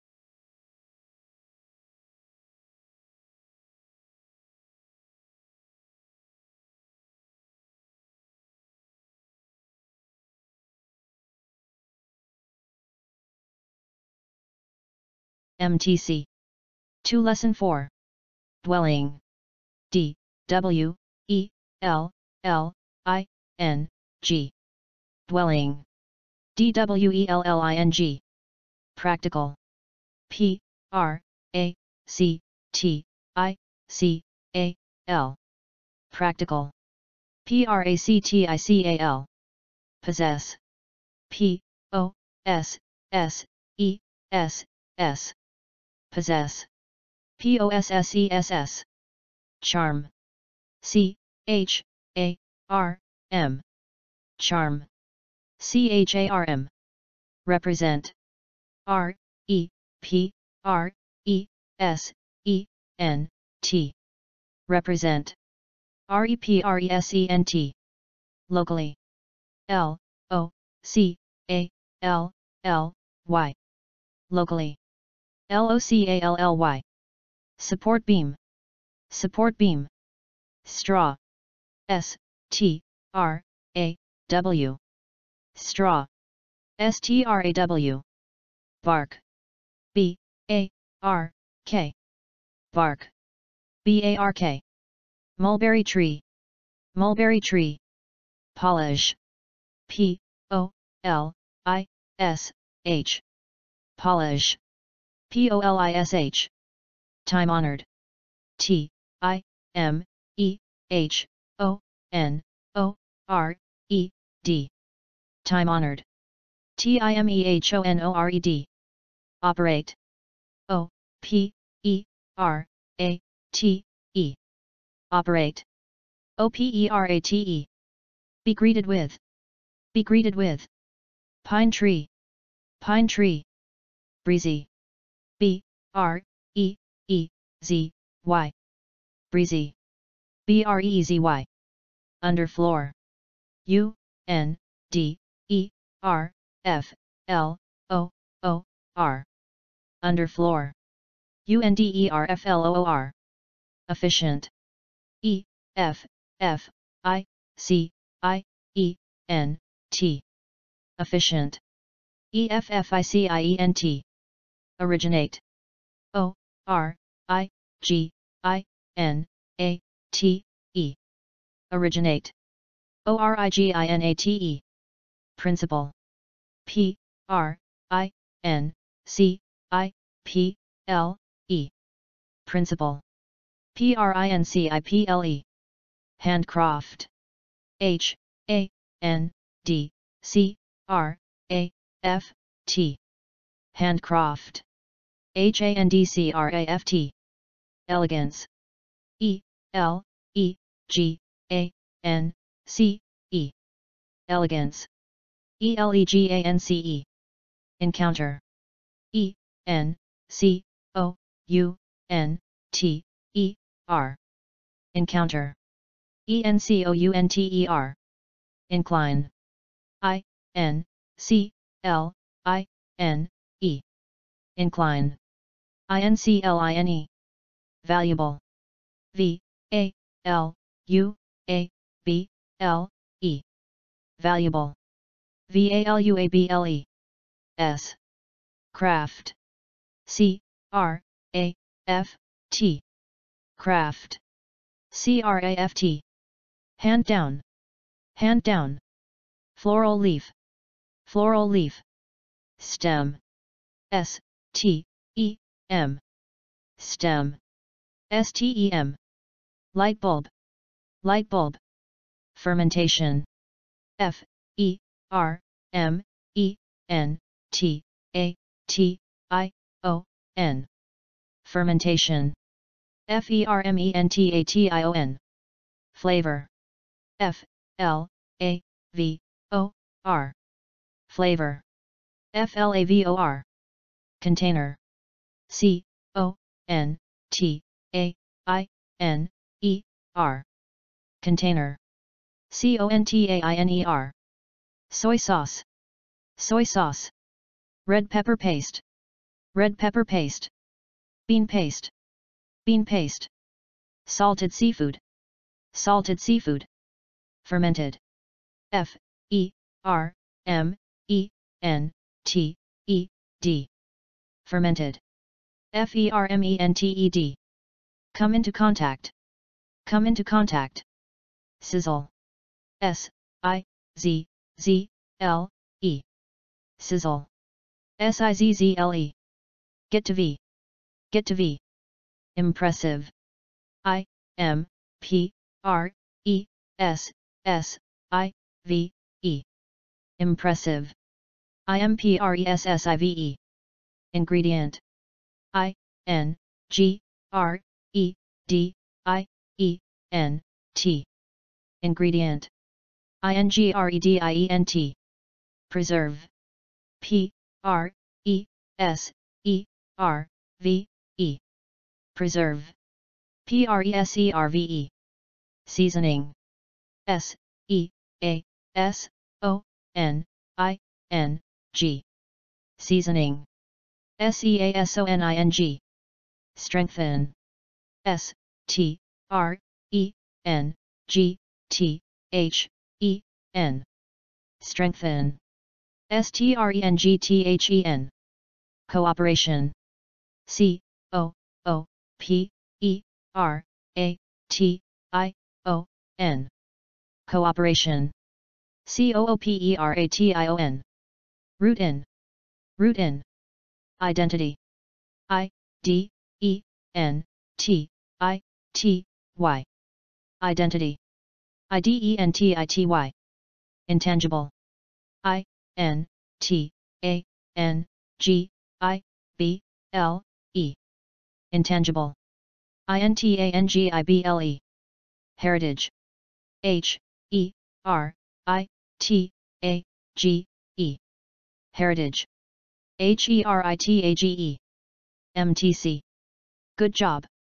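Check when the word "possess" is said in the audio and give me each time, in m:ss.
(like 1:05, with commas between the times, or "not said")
0:40, 0:46.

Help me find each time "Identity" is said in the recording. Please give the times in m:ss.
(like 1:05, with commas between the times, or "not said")
6:44, 6:50.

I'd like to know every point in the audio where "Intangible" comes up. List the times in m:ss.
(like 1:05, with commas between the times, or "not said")
6:53, 7:01.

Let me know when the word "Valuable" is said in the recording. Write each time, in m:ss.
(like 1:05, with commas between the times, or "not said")
3:47, 3:54.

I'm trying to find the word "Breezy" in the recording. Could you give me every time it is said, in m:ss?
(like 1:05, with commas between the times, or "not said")
2:14, 2:19.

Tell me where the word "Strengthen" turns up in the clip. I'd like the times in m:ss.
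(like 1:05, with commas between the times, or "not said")
6:16, 6:24.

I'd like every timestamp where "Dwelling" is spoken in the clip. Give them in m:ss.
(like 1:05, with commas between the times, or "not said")
0:18, 0:25.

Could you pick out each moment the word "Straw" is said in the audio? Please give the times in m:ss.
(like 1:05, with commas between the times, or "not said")
1:20, 1:25.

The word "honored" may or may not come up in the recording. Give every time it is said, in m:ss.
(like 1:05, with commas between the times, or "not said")
1:47, 1:55.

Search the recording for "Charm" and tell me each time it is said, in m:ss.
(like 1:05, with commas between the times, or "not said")
0:49, 0:54.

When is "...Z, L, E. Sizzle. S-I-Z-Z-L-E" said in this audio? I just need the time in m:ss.
5:24.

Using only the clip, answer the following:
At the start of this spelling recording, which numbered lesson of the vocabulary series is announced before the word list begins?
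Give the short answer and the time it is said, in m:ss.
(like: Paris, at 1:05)
Lesson 4, at 0:17.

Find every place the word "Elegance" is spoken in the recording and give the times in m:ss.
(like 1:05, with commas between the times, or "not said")
3:17, 3:24.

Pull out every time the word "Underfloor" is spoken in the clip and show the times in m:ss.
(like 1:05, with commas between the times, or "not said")
2:22, 2:30.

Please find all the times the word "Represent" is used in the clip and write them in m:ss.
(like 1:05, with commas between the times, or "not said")
0:57, 1:04.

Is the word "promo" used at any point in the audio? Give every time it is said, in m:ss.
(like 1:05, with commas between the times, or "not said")
not said.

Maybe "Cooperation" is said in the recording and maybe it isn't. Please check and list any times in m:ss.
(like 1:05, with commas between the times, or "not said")
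6:28, 6:37.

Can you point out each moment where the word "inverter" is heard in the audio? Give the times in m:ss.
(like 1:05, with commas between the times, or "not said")
not said.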